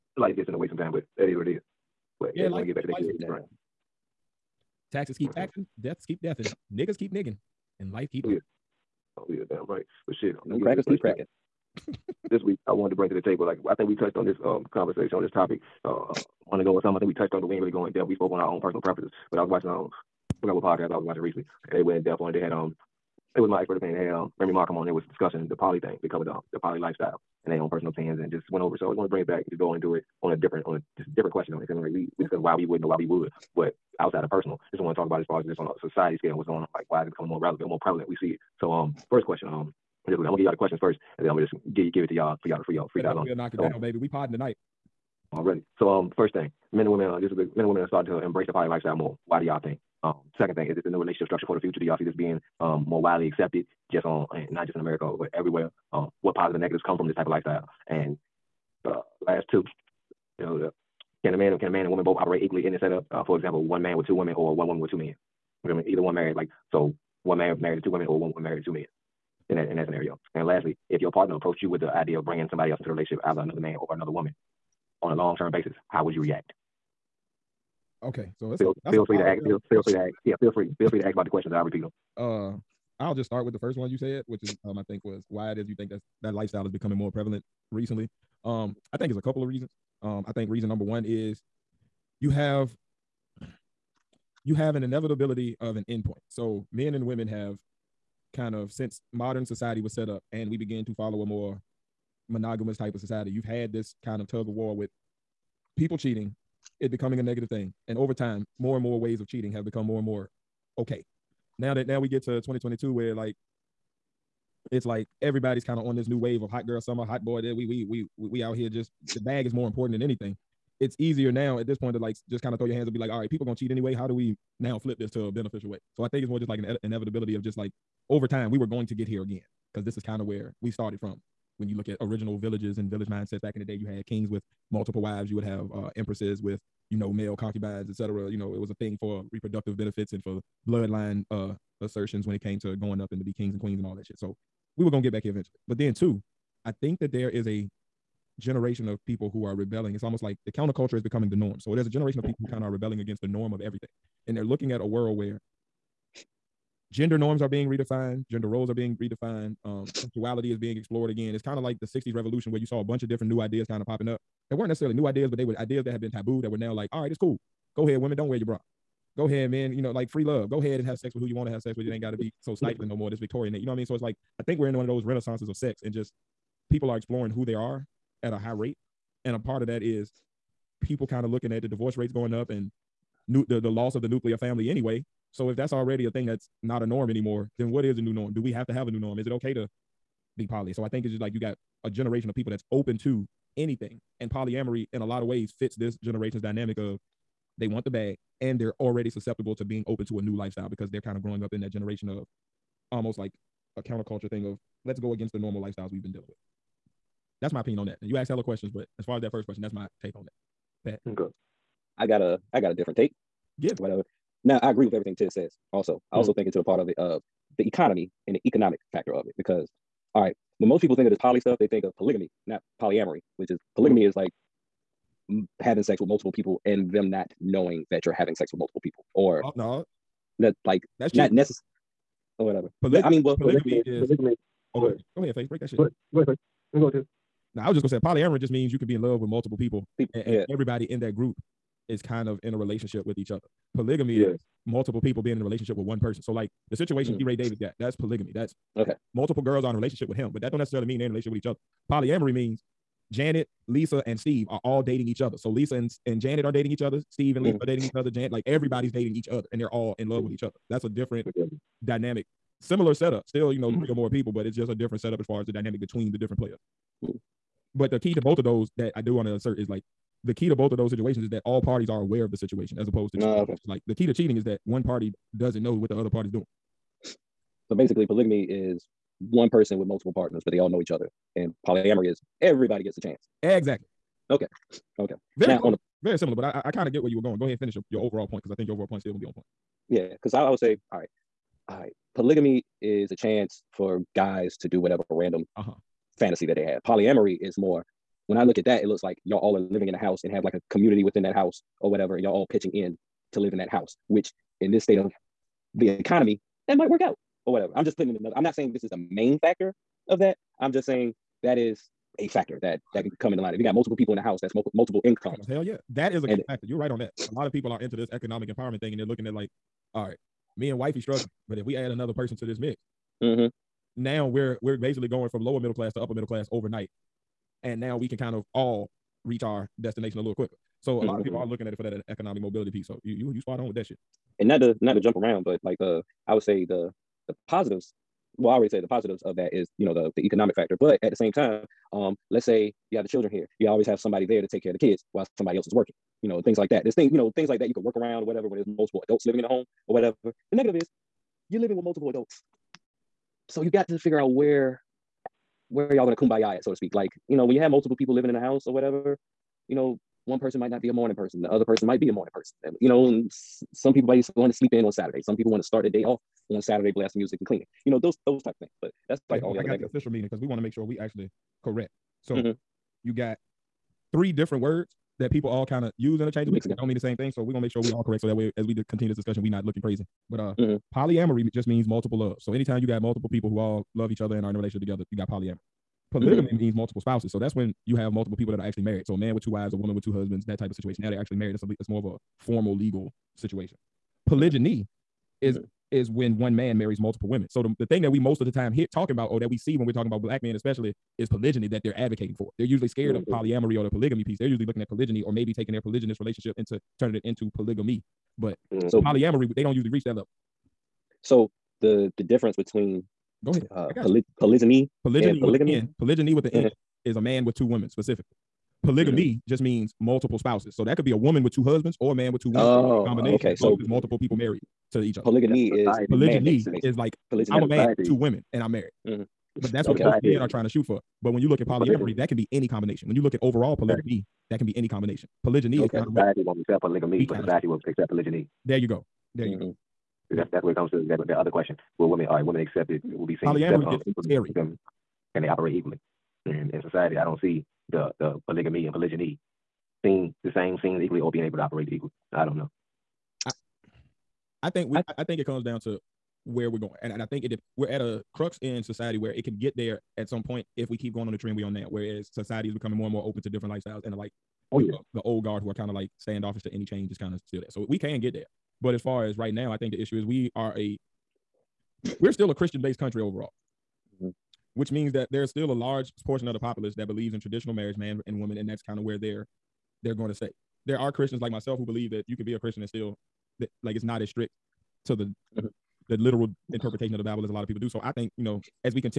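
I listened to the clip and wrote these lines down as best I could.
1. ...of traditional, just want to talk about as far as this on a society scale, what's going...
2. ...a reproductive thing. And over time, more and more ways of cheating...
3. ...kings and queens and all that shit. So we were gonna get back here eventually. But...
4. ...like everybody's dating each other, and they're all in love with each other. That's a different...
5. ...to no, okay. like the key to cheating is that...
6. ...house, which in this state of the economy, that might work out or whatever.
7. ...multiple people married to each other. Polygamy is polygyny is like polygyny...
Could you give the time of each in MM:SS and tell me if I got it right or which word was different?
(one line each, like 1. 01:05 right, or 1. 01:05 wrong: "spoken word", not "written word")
1. 00:34 wrong: "personal", not "traditional"
2. 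01:47 wrong: "negative", not "reproductive"
3. 02:23 right
4. 04:18 right
5. 04:33 right
6. 05:03 right
7. 07:03 right.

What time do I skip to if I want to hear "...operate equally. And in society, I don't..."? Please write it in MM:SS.
07:25.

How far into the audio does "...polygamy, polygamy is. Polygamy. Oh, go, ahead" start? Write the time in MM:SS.
03:53.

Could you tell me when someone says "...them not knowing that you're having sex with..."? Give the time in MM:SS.
03:46.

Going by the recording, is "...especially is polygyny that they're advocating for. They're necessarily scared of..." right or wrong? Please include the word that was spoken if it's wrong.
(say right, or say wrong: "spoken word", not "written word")
wrong: "usually", not "necessarily".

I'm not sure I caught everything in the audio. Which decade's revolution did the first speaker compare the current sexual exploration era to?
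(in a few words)
The 60s.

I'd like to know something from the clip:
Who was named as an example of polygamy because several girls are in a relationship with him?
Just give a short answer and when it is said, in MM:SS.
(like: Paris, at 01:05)
D. Ray Davis, at 04:07.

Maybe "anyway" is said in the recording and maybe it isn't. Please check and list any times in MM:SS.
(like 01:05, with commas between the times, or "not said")
02:03, 03:04.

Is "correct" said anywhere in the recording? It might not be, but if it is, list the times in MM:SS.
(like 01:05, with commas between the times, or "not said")
06:11, 06:18.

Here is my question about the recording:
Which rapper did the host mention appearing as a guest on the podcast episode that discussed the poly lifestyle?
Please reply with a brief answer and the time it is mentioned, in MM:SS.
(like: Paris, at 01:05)
Remy Ma, at 00:24.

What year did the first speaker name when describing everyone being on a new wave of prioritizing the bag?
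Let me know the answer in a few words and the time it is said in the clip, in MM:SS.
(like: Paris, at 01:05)
2022, at 01:52.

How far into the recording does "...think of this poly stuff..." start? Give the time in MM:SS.
03:40.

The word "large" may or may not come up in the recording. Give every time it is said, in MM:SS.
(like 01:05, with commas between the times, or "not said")
07:55.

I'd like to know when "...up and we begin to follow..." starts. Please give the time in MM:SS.
01:40.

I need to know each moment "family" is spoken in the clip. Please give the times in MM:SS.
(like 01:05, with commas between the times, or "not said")
03:04.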